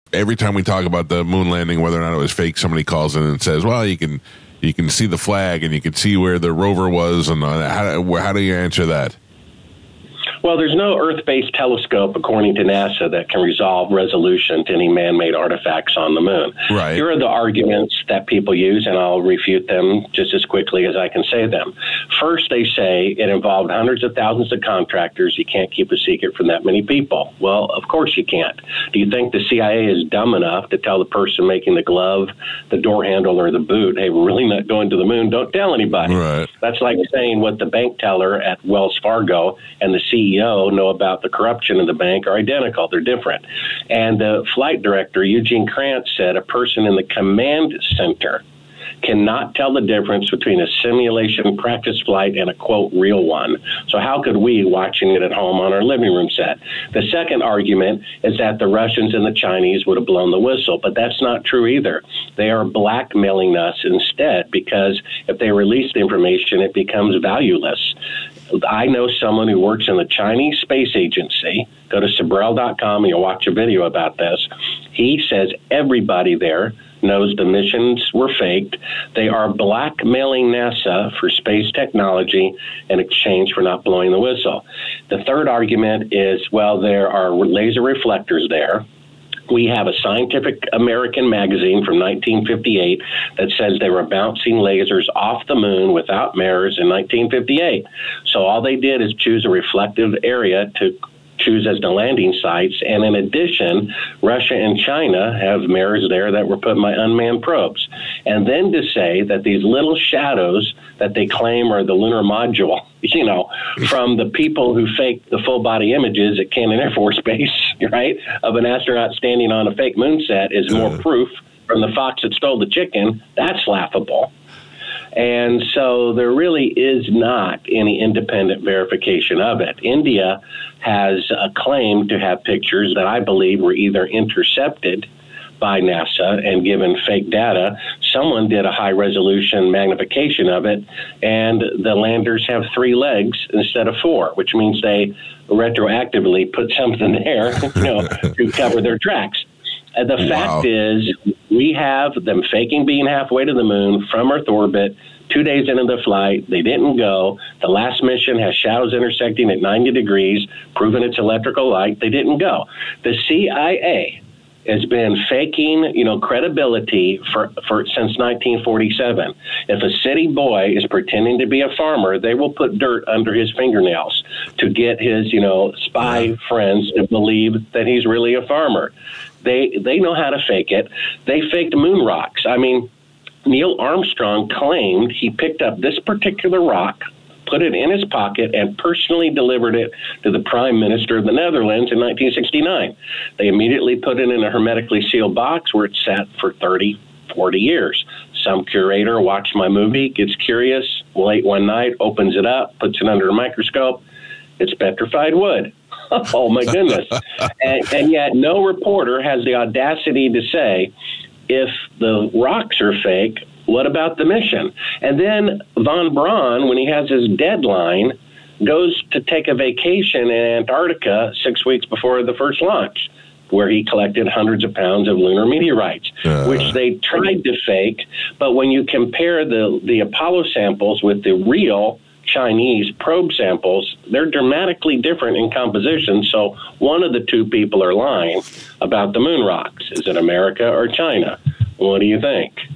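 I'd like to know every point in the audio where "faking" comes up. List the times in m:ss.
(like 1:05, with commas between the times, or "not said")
2:32, 2:45.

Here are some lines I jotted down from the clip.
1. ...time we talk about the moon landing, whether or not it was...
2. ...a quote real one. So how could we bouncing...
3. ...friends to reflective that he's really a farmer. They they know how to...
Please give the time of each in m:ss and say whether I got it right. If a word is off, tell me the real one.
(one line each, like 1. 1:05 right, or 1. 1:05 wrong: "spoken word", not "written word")
1. 0:00 right
2. 0:52 wrong: "watching", not "bouncing"
3. 2:56 wrong: "believe", not "reflective".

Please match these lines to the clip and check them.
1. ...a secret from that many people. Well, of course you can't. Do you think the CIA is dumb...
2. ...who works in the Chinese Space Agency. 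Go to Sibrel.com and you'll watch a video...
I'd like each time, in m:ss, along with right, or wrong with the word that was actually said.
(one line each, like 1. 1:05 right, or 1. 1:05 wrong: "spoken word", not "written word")
1. 0:25 right
2. 1:09 right.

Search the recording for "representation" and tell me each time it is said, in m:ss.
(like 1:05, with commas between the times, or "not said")
not said.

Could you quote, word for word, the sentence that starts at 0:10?
Well, there's no Earth based telescope, according to NASA, that can resolve resolution to any man made artifacts on the moon.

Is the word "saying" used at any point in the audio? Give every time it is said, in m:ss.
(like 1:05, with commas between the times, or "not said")
0:37.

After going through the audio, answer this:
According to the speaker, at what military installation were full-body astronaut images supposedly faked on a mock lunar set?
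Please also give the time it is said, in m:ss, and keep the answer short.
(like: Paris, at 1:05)
Cannon Air Force Base, at 1:56.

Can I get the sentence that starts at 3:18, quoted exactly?
Some curator watched my movie, gets curious, late one night, opens it up, puts it under a microscope.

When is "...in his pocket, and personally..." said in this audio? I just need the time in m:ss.
3:07.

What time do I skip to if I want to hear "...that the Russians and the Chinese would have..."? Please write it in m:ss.
0:58.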